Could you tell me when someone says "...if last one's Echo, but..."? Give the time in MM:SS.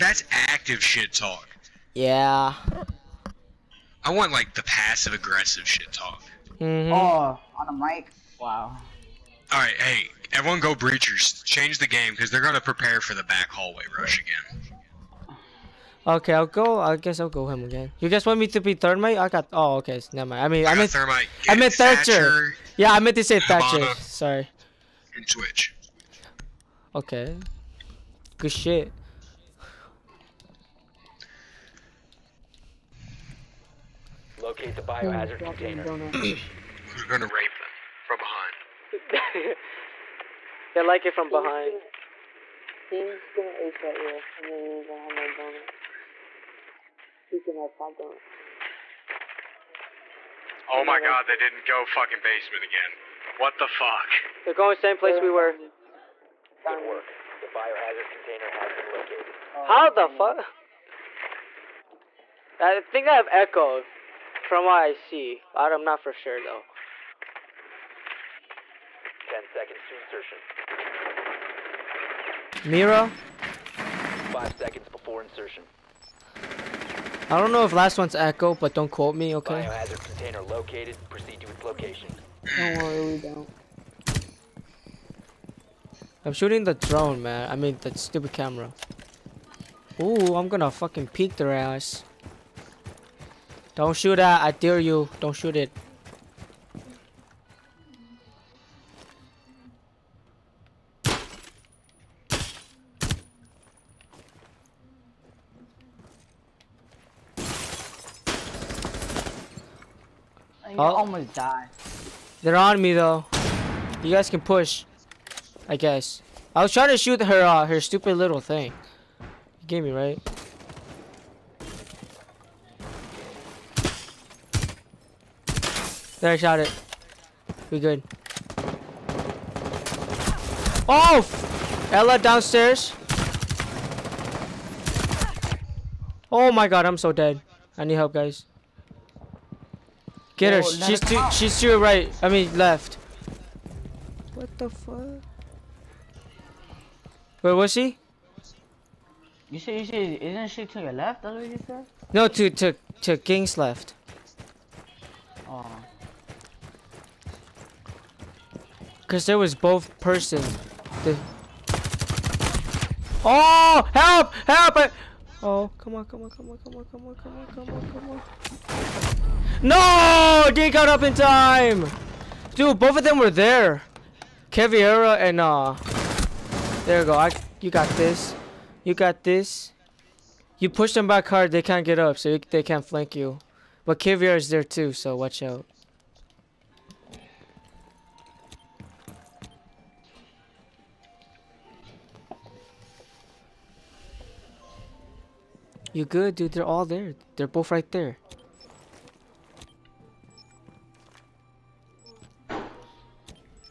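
01:17.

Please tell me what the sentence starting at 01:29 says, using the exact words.
Ooh, I'm gonna fucking peek their ass.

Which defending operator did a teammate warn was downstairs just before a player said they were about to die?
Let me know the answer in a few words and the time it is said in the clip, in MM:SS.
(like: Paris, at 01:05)
Ela, at 02:11.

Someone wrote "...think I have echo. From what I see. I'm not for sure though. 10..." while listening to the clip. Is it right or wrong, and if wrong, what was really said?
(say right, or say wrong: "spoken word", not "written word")
right.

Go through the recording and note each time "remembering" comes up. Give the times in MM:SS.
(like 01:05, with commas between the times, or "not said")
not said.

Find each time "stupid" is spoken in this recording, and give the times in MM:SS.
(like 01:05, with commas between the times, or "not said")
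01:27, 01:57.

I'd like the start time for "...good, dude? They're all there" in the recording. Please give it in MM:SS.
03:16.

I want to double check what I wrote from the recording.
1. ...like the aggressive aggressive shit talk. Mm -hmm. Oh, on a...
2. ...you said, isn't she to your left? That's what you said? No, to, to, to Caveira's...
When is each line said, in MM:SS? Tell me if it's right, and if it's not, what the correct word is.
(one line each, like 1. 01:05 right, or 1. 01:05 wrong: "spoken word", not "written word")
1. 00:04 wrong: "passive", not "aggressive"
2. 02:29 wrong: "King", not "Caveira".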